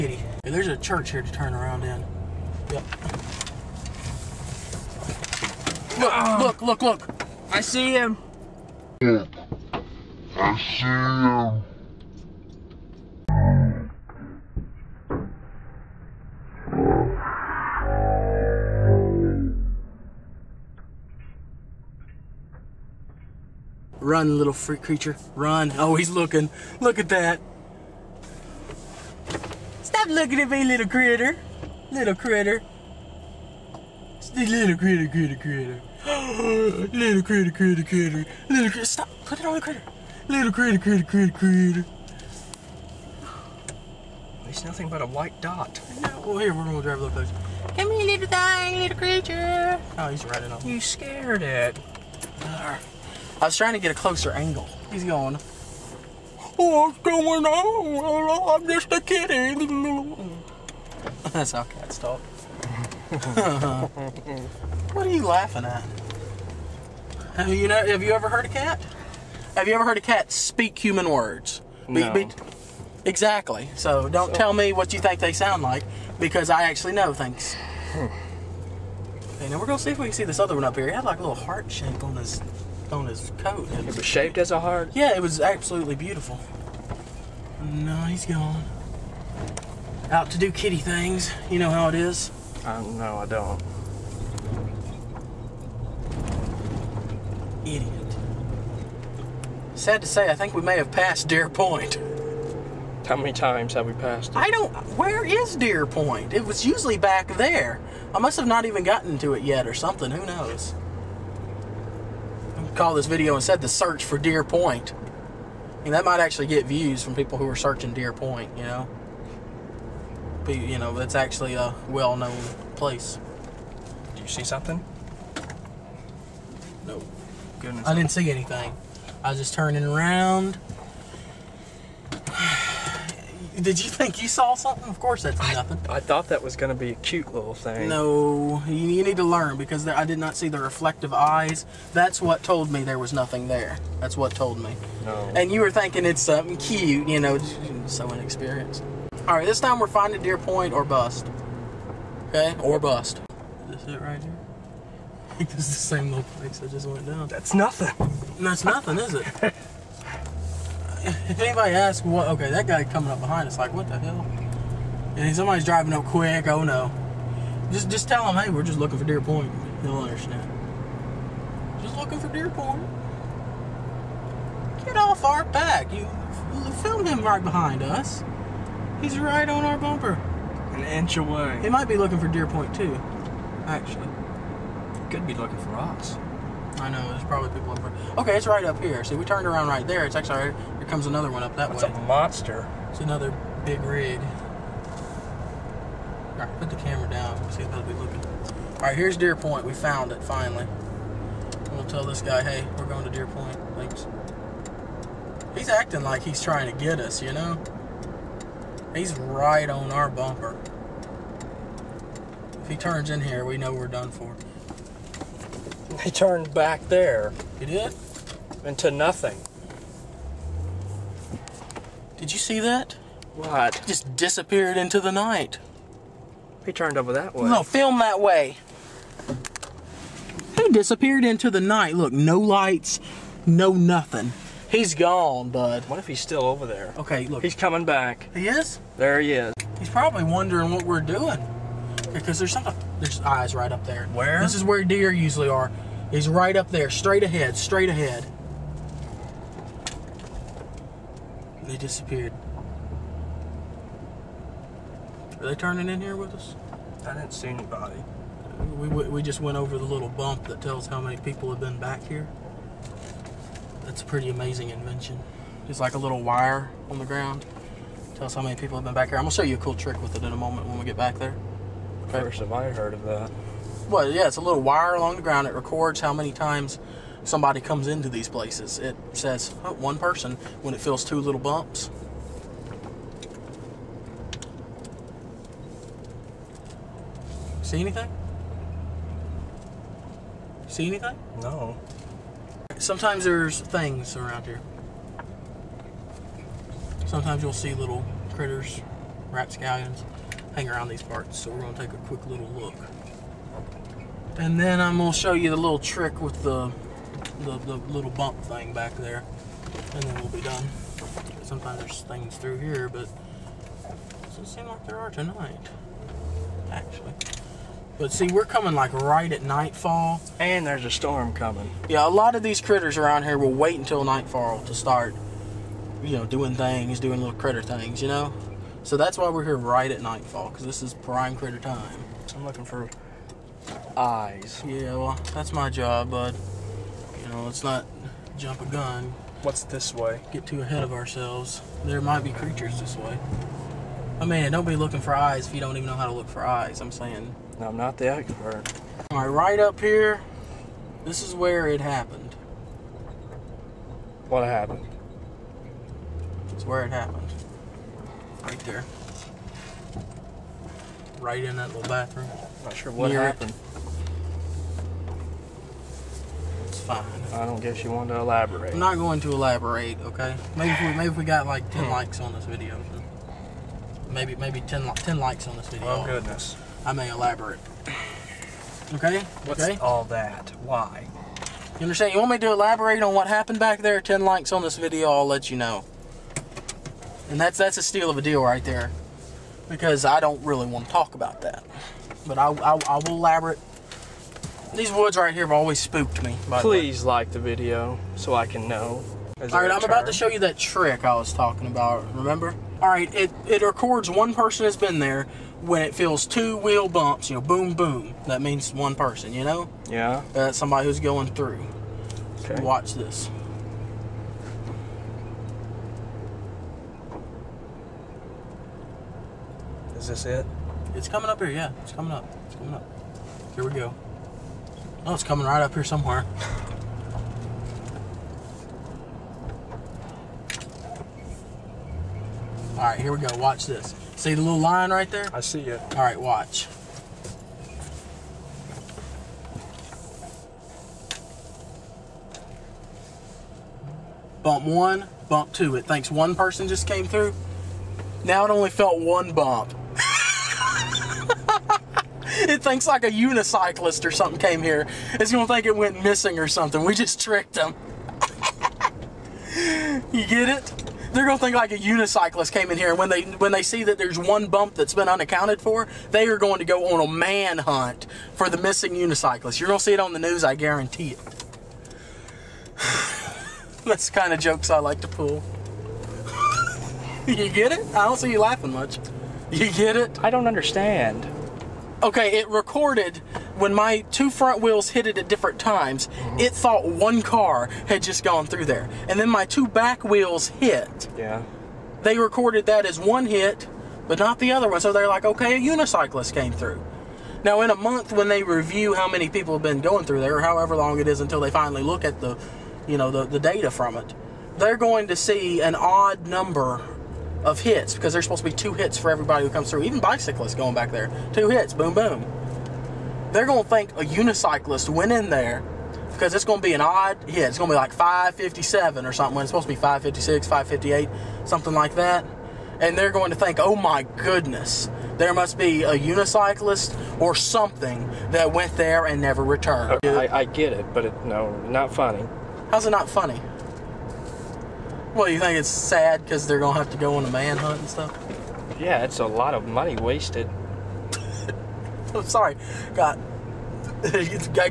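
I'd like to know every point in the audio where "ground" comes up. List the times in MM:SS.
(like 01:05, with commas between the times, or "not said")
04:27, 04:35.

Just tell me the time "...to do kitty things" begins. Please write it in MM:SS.
01:30.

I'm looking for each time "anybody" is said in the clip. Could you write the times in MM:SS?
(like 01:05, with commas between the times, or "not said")
02:41, 04:17.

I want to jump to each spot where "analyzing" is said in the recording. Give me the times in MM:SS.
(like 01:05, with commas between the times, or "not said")
not said.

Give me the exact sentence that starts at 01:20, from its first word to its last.
He had like a little heart shape on his on his coat.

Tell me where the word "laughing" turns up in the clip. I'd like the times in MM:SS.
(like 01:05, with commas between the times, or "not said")
01:05, 07:58.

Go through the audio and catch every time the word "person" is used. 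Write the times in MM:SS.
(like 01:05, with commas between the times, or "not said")
04:39, 06:44, 06:48, 07:26.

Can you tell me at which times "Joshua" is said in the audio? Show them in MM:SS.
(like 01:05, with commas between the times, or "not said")
not said.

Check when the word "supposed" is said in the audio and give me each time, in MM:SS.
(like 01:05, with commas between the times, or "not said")
08:28, 08:39.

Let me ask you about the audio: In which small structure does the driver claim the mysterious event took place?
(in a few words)
bathroom.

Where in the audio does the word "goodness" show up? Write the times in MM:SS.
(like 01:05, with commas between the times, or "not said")
02:07, 06:16, 08:44.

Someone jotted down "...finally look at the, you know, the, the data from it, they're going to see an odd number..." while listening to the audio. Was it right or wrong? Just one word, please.
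right.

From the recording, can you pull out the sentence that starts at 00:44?
It's nothing but a white dot.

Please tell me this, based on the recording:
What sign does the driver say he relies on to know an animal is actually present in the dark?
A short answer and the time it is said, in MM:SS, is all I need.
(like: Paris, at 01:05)
reflective eyes, at 02:20.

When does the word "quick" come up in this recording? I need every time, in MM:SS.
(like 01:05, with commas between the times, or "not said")
02:46, 05:02.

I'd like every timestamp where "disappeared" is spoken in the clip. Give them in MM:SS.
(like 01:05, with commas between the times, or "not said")
03:44, 03:50, 04:11.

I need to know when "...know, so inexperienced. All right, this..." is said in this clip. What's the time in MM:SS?
02:27.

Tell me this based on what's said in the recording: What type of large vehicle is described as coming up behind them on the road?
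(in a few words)
big rig.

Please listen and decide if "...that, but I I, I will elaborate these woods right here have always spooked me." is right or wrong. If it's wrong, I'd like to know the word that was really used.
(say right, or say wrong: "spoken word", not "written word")
right.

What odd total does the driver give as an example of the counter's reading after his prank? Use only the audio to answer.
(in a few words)
557.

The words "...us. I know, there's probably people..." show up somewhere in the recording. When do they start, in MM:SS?
03:05.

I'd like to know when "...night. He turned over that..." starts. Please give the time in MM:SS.
03:45.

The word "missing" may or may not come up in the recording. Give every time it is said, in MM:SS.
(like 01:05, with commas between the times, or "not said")
07:36, 07:48.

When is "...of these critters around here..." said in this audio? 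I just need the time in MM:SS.
05:22.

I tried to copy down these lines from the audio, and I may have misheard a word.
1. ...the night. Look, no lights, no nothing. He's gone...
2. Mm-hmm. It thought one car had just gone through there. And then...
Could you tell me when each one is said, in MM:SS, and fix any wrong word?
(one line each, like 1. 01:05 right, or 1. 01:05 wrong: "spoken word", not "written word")
1. 03:51 right
2. 08:06 right.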